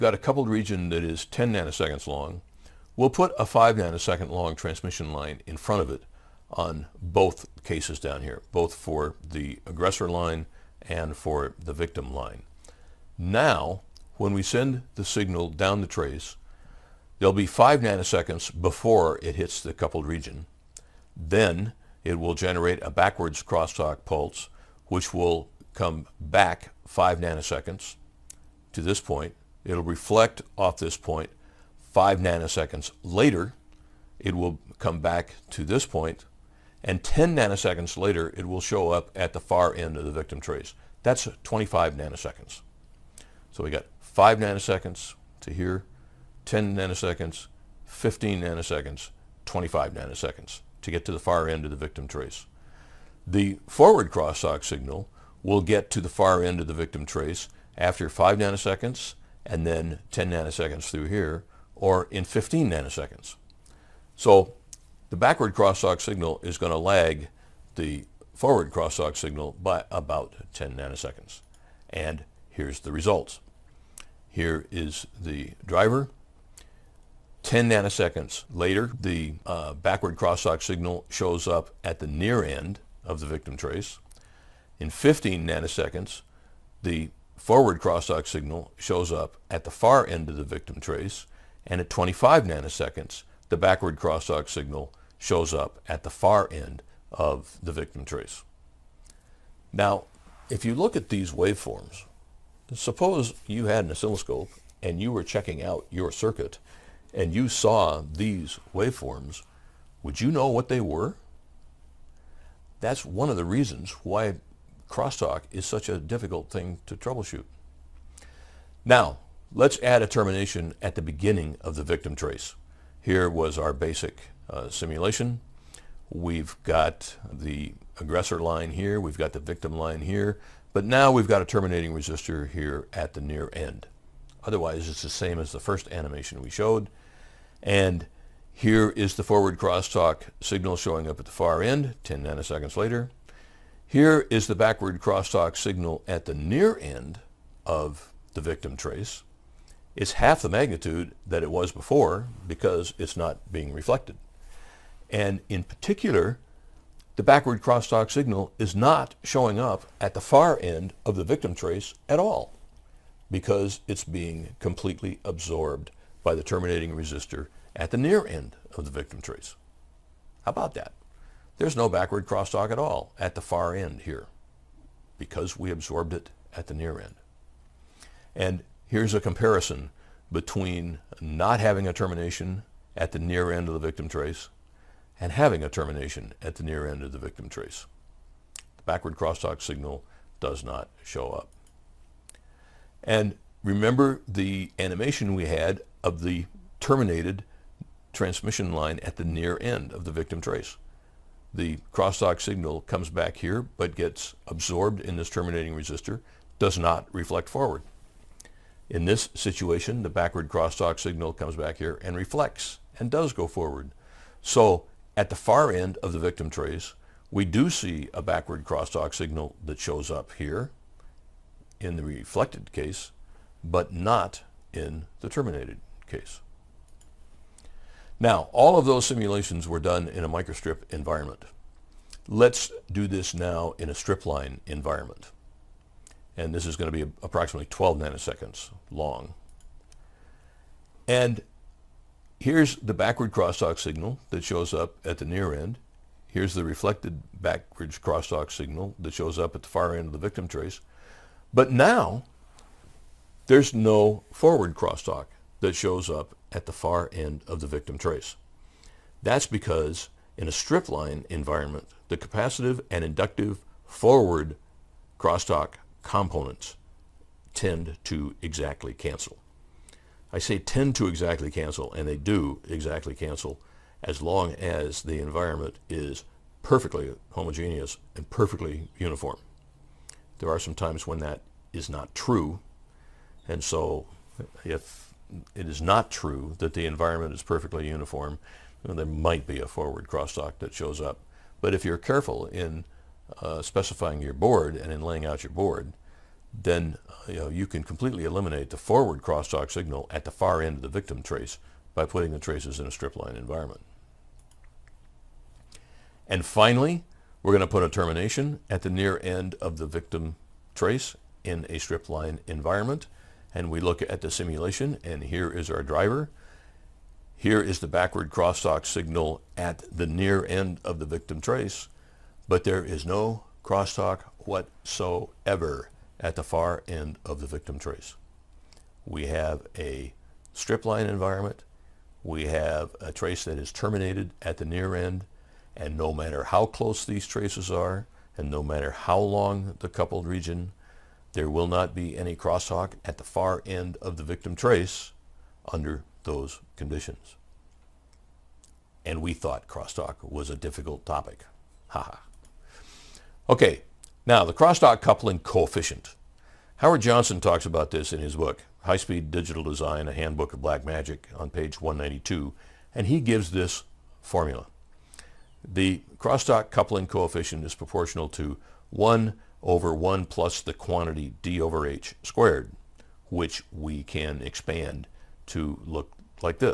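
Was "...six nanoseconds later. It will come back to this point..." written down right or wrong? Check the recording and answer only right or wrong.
wrong.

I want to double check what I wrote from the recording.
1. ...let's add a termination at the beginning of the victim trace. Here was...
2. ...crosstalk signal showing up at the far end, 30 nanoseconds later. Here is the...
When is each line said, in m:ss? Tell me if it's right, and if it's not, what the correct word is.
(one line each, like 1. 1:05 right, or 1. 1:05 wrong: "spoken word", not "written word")
1. 1:59 right
2. 2:19 wrong: "10", not "30".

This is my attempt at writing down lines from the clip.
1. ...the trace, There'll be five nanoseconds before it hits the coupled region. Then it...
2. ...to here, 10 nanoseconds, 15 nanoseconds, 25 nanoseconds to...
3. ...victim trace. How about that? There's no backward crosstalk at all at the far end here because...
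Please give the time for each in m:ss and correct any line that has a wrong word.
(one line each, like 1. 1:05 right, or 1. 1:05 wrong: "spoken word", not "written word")
1. 0:15 right
2. 0:45 right
3. 2:48 right.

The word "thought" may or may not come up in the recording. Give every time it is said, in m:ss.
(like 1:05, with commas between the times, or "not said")
5:49.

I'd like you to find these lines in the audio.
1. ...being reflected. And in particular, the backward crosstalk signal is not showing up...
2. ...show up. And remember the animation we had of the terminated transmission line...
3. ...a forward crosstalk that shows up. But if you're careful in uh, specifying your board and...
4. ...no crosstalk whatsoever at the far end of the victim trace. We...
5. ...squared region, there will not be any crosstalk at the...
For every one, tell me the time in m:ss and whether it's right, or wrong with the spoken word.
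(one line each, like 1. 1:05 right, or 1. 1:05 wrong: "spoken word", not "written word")
1. 2:33 right
2. 3:11 right
3. 4:49 right
4. 5:23 right
5. 5:39 wrong: "coupled", not "squared".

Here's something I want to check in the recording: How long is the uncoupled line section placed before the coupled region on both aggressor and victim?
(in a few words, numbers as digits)
5 nanoseconds.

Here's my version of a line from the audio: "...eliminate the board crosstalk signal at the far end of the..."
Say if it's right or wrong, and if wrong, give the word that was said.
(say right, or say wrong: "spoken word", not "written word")
wrong: "forward", not "board".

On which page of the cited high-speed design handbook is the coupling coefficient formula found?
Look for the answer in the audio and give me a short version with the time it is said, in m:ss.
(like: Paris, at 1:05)
192, at 6:01.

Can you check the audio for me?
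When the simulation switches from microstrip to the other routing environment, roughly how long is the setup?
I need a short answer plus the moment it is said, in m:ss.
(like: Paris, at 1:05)
12 nanoseconds, at 3:57.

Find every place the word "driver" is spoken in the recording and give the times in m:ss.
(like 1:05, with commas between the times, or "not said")
1:15, 5:15.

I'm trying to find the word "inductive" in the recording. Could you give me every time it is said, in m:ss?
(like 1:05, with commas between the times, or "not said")
4:23.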